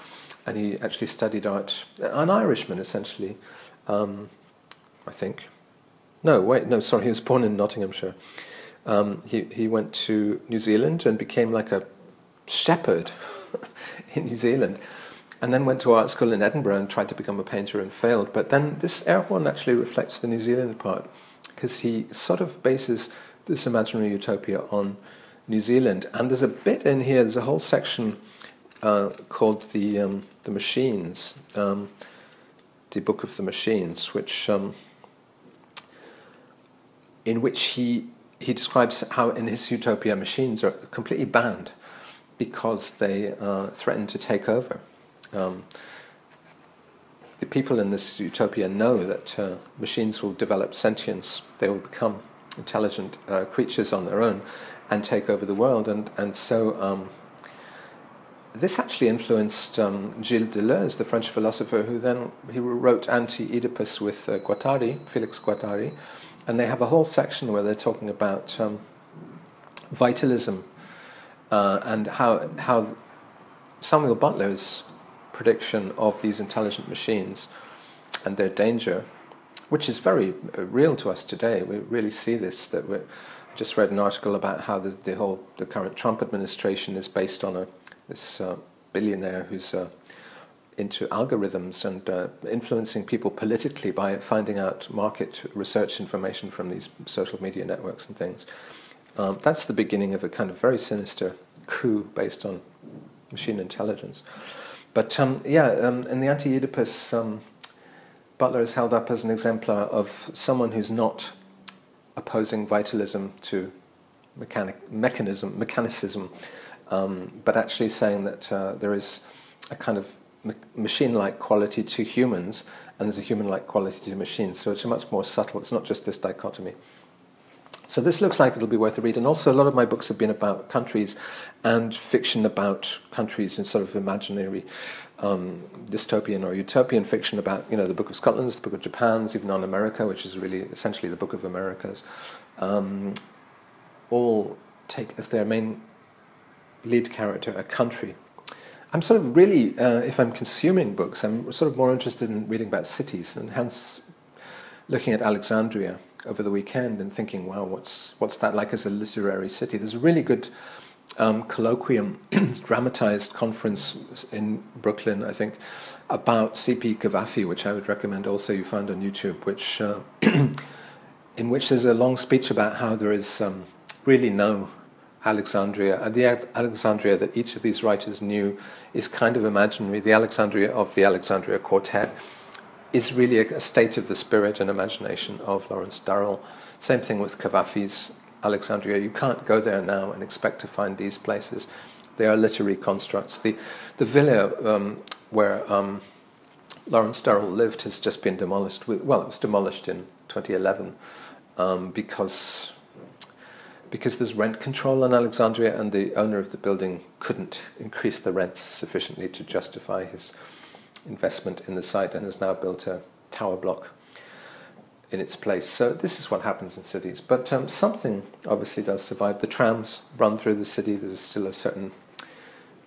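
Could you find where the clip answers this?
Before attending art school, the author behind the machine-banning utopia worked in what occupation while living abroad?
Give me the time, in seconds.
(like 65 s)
12 s.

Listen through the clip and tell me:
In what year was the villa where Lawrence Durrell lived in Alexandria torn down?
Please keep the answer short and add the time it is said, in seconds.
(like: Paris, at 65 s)
2011, at 200 s.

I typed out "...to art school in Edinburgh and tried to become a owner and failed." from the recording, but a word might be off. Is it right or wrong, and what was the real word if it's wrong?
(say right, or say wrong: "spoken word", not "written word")
wrong: "painter", not "owner".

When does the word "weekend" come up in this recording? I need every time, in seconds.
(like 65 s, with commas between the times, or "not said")
156 s.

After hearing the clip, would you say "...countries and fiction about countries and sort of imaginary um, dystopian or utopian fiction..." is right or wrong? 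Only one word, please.
right.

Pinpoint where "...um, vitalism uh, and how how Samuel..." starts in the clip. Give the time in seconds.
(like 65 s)
68 s.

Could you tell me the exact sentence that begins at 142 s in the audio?
Um, all take as their main lead character a country.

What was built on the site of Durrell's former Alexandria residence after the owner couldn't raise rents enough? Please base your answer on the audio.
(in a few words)
A tower block.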